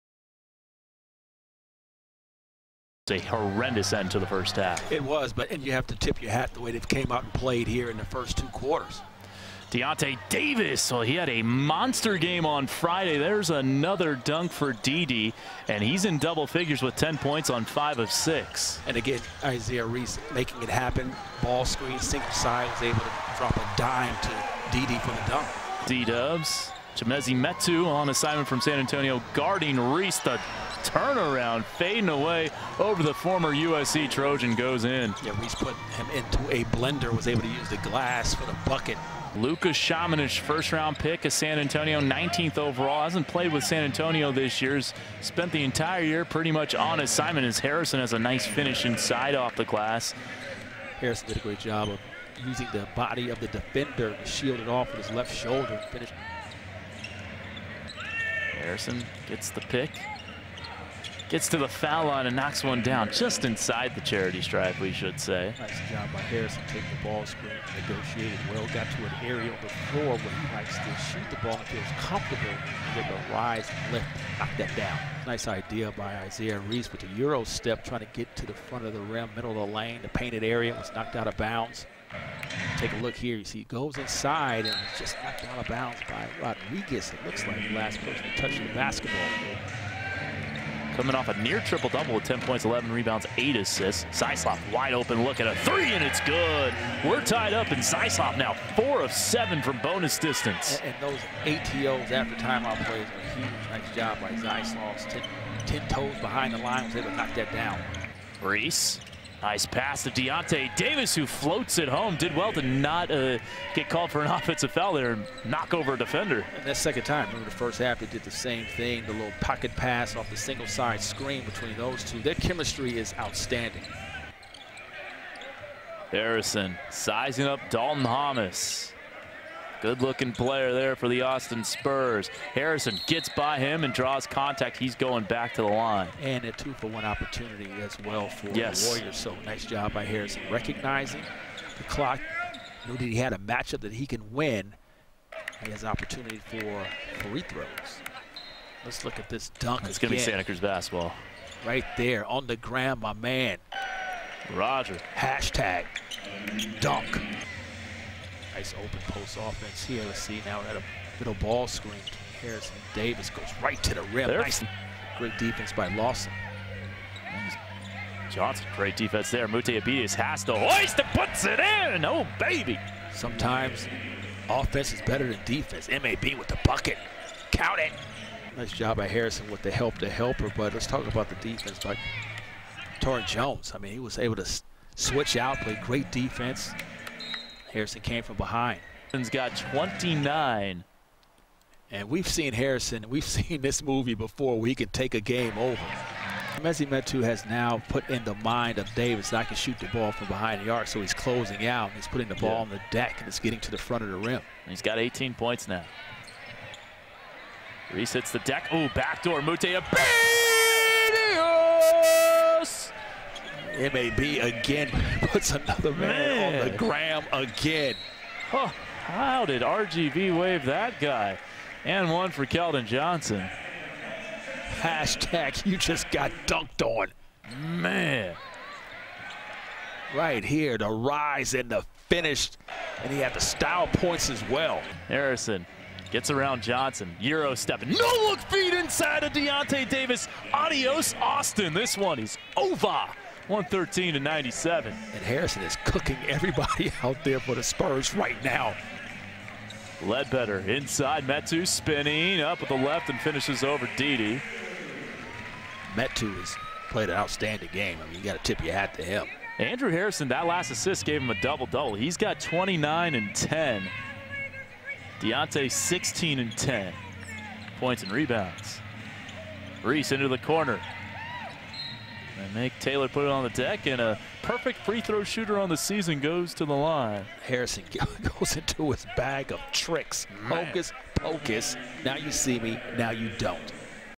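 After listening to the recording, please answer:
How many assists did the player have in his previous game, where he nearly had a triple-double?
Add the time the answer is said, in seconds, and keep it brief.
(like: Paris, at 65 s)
8, at 93 s.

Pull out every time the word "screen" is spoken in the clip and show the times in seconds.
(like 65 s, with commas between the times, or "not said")
21 s, 67 s, 121 s, 161 s.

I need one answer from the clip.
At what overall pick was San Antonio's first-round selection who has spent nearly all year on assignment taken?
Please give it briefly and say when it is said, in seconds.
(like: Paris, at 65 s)
19th, at 42 s.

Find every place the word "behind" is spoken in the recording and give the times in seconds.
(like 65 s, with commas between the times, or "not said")
106 s, 188 s, 200 s.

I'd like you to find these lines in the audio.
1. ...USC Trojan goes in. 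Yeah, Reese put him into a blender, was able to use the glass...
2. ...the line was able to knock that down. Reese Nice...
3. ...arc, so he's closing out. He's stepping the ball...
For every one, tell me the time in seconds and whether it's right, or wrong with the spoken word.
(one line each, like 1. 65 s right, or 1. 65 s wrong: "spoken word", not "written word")
1. 33 s right
2. 106 s right
3. 200 s wrong: "putting", not "stepping".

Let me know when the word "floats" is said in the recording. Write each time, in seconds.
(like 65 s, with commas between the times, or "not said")
111 s.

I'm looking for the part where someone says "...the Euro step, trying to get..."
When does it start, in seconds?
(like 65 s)
76 s.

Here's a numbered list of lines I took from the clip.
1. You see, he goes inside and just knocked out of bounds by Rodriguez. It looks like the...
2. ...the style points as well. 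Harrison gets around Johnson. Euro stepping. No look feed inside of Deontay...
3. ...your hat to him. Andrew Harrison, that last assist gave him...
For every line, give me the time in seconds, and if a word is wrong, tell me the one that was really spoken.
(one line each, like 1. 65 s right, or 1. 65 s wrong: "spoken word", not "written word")
1. 83 s right
2. 233 s right
3. 258 s right.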